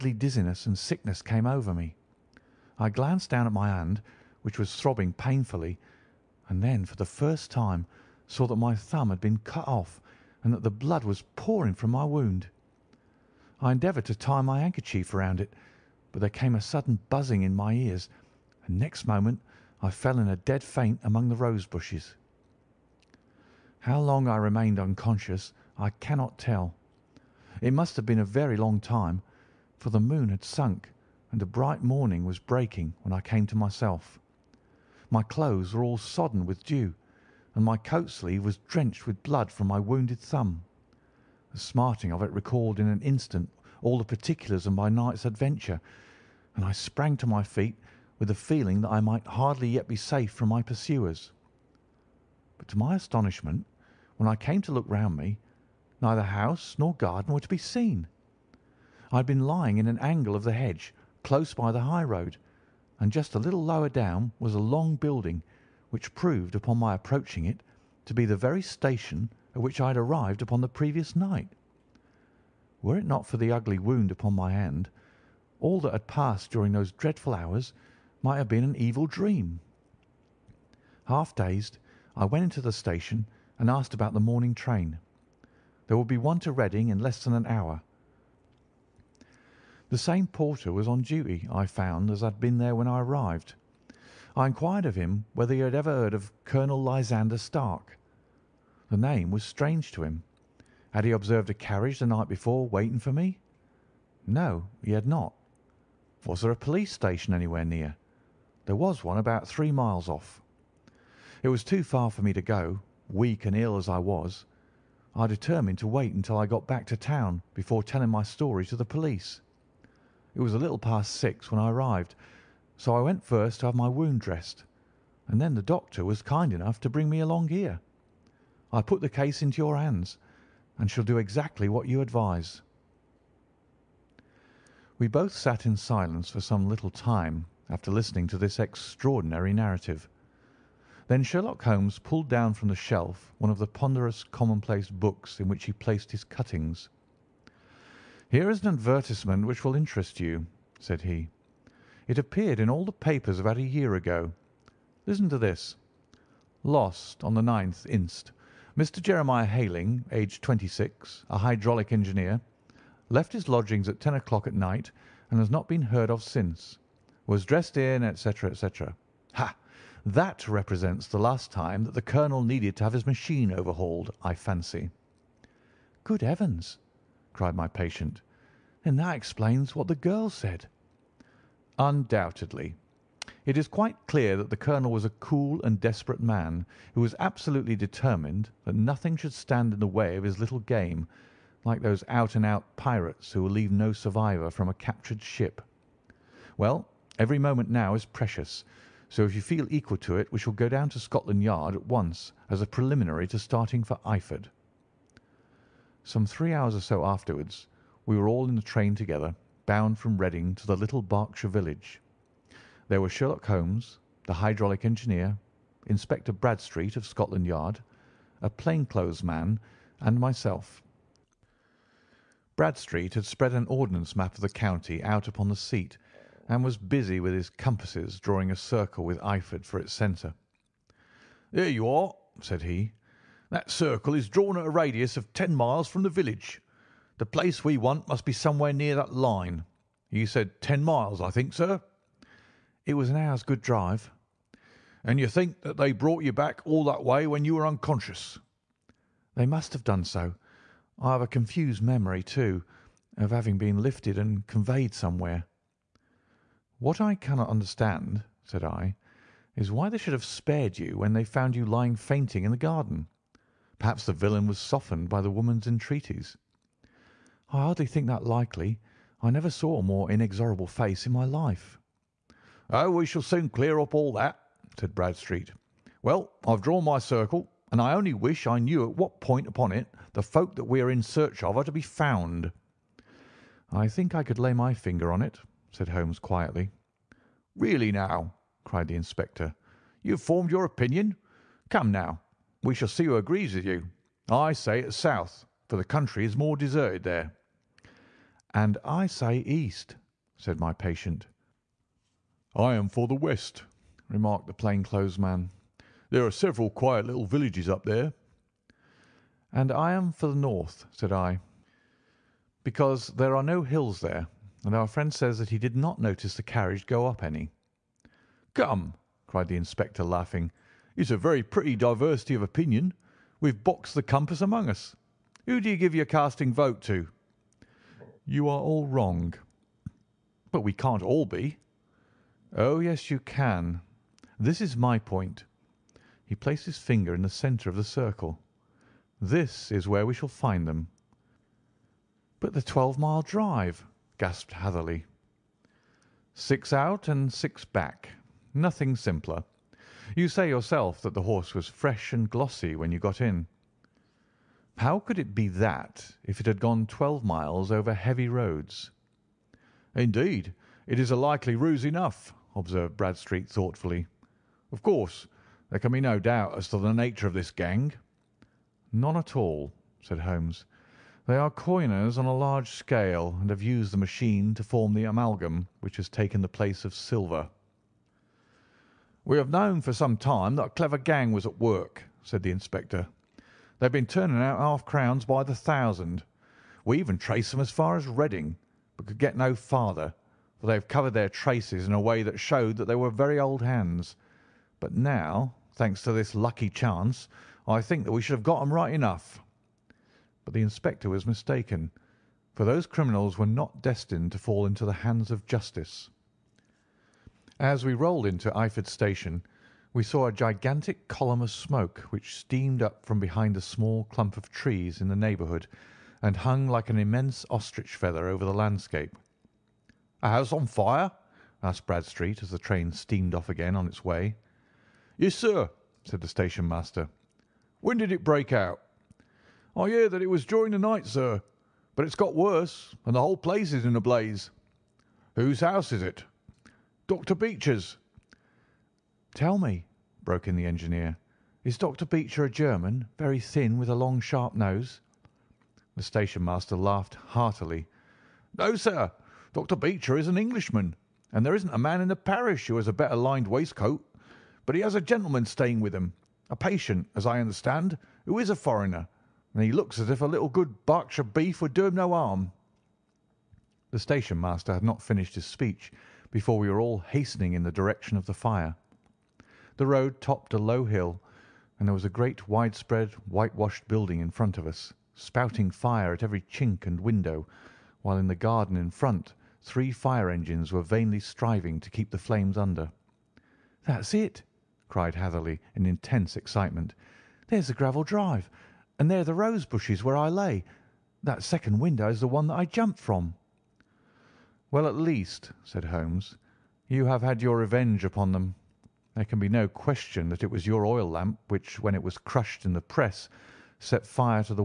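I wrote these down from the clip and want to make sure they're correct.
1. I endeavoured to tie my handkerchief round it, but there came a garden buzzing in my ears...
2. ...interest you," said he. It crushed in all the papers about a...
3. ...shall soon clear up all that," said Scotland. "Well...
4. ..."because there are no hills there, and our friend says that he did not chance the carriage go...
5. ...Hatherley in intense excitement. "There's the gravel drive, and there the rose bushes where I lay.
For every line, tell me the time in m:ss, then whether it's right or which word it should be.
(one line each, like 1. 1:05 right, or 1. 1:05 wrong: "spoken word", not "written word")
1. 0:13 wrong: "sudden", not "garden"
2. 2:29 wrong: "appeared", not "crushed"
3. 4:33 wrong: "Bradstreet", not "Scotland"
4. 5:12 wrong: "notice", not "chance"
5. 8:05 right.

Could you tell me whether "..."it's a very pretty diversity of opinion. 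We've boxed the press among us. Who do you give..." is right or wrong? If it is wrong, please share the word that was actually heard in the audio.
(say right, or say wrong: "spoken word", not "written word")
wrong: "compass", not "press".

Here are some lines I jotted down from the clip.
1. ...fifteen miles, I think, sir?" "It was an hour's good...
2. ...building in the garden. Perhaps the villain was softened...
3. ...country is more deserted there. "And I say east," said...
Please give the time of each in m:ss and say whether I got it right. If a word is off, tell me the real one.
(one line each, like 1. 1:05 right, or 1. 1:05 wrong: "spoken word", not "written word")
1. 4:00 wrong: "ten", not "fifteen"
2. 4:21 wrong: "fainting", not "building"
3. 4:55 right.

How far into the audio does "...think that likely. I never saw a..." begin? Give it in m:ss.
4:27.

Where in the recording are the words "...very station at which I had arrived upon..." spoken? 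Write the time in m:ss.
1:08.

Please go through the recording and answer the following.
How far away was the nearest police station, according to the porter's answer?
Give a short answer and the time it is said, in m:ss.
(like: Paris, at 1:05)
3 miles, at 1:49.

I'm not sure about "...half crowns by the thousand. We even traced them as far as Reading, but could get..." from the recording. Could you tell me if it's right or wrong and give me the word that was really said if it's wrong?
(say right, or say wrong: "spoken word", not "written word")
right.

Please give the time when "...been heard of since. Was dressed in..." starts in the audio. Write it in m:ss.
2:45.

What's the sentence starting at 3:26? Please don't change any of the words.
Some three hours or so afterwards we were all in the train together bound from Reading to the little Berkshire village.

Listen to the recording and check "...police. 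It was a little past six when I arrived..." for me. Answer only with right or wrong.
right.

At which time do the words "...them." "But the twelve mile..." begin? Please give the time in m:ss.
5:40.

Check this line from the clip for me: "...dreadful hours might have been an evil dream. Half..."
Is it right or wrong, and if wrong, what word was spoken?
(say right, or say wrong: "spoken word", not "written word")
right.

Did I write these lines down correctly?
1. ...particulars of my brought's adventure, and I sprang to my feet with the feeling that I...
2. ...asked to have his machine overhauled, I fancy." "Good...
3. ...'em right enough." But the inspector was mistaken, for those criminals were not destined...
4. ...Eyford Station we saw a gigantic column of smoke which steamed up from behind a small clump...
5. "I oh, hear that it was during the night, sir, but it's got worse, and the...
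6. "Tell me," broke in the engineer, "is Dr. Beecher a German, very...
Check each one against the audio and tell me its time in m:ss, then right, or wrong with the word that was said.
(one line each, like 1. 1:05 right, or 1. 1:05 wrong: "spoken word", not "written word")
1. 0:44 wrong: "night", not "brought"
2. 2:52 wrong: "needed", not "asked"
3. 6:38 right
4. 6:48 right
5. 7:09 right
6. 7:19 right.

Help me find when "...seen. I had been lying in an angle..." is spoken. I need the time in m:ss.
0:57.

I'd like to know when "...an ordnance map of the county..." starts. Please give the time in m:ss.
3:43.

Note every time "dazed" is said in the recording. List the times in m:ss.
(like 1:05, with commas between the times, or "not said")
1:21.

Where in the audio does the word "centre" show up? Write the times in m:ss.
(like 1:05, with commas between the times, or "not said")
3:49, 5:37.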